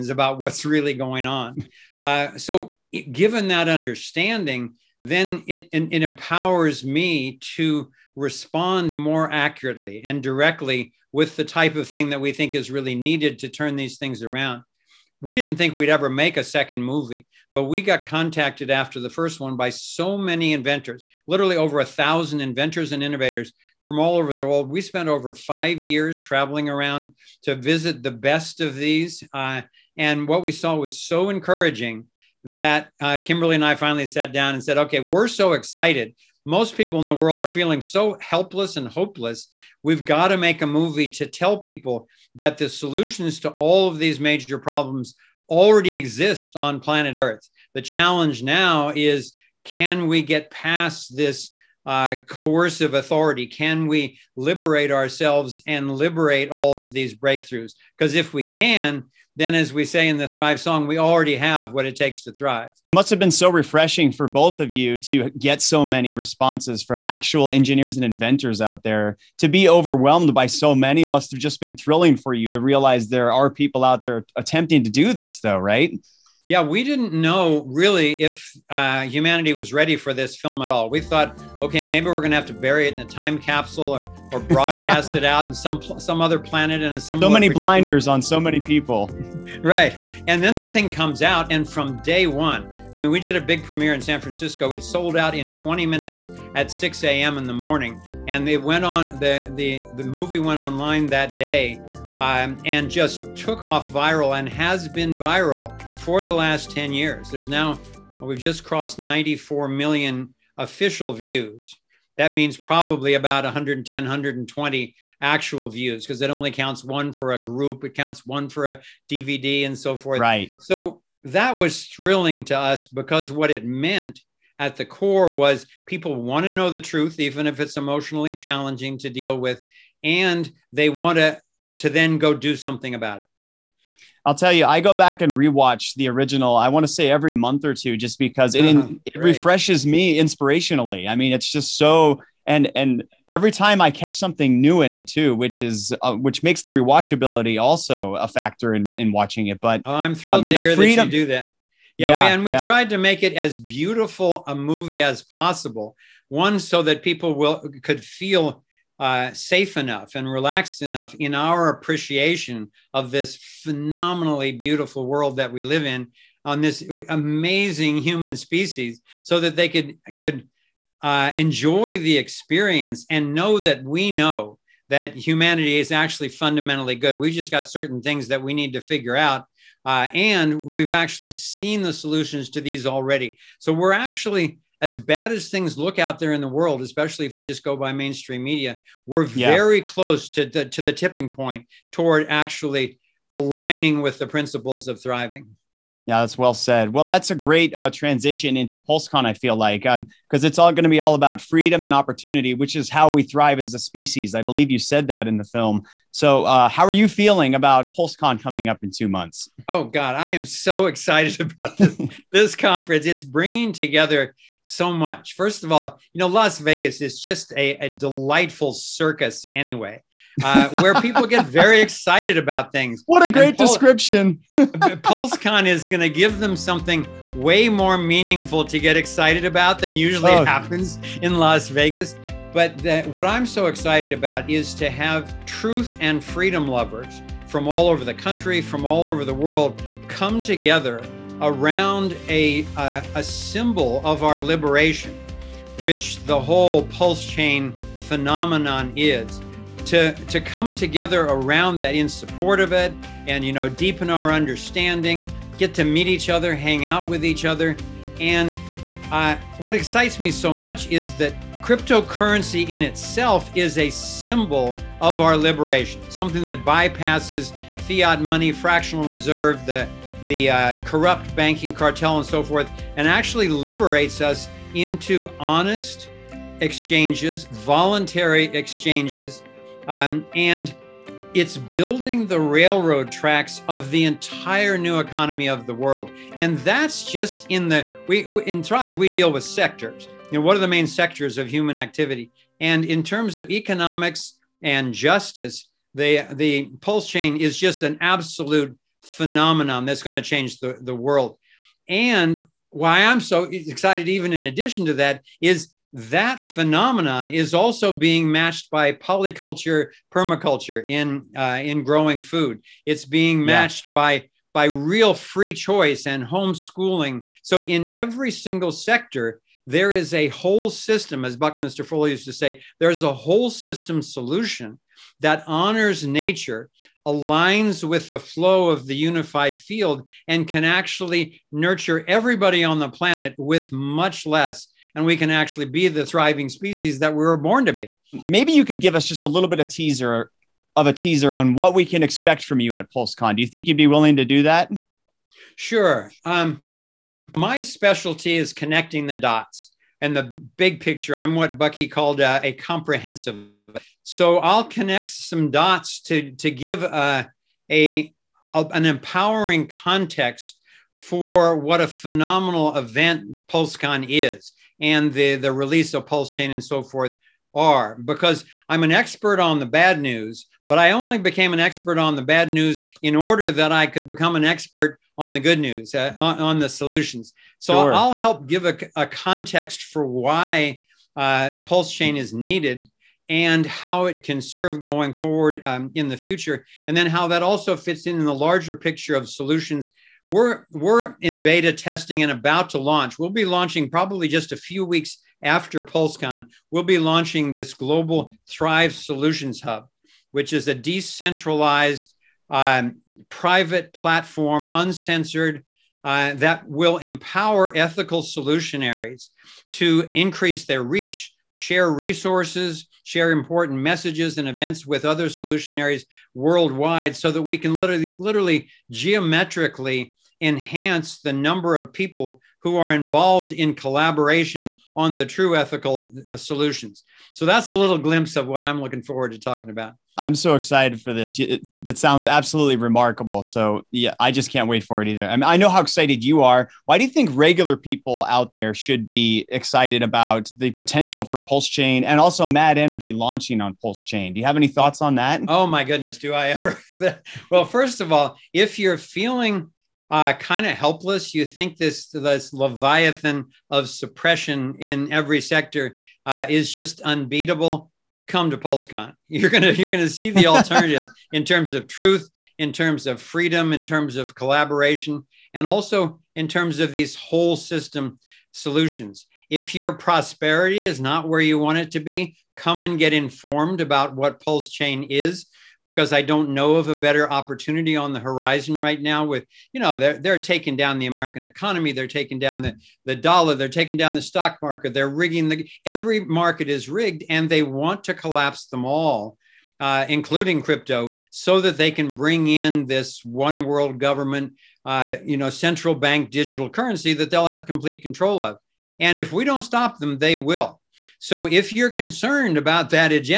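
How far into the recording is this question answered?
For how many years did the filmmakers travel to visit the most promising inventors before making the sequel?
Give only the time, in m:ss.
0:25.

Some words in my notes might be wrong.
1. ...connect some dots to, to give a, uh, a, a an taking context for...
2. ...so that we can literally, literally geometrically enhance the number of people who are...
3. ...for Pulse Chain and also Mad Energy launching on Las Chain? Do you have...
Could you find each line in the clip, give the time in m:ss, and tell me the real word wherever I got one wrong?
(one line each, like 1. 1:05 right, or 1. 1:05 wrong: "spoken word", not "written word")
1. 5:54 wrong: "empowering", not "taking"
2. 6:57 right
3. 7:21 wrong: "Pulse", not "Las".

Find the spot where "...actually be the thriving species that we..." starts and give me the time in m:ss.
5:35.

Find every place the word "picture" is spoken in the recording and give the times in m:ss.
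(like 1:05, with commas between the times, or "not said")
5:50, 6:28.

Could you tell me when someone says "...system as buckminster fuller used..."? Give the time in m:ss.
5:20.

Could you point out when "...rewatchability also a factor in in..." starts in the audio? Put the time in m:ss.
2:26.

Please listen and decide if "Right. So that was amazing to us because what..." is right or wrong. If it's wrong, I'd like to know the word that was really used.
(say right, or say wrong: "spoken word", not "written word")
wrong: "thrilling", not "amazing".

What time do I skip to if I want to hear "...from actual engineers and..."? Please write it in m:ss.
1:06.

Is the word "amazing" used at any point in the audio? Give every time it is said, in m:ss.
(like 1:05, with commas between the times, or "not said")
2:47.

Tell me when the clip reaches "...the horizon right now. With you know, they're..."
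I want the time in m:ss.
7:58.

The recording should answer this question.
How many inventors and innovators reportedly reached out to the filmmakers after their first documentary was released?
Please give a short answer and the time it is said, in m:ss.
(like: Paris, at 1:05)
over 1000, at 0:21.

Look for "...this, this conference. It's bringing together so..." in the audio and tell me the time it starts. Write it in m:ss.
3:31.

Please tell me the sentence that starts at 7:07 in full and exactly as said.
So that's a little glimpse of what I'm looking forward to talking about.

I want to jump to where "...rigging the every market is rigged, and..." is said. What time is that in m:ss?
8:05.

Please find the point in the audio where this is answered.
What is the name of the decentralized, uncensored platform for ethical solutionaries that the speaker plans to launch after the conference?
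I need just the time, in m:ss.
6:38.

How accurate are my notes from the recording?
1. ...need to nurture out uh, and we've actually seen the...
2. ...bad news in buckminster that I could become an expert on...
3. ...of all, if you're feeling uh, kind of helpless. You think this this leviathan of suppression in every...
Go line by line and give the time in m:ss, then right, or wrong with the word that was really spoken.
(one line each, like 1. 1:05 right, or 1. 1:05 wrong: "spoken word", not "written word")
1. 2:58 wrong: "figure", not "nurture"
2. 6:12 wrong: "order", not "buckminster"
3. 7:27 right.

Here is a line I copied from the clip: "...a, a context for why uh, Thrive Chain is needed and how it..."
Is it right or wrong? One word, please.
wrong.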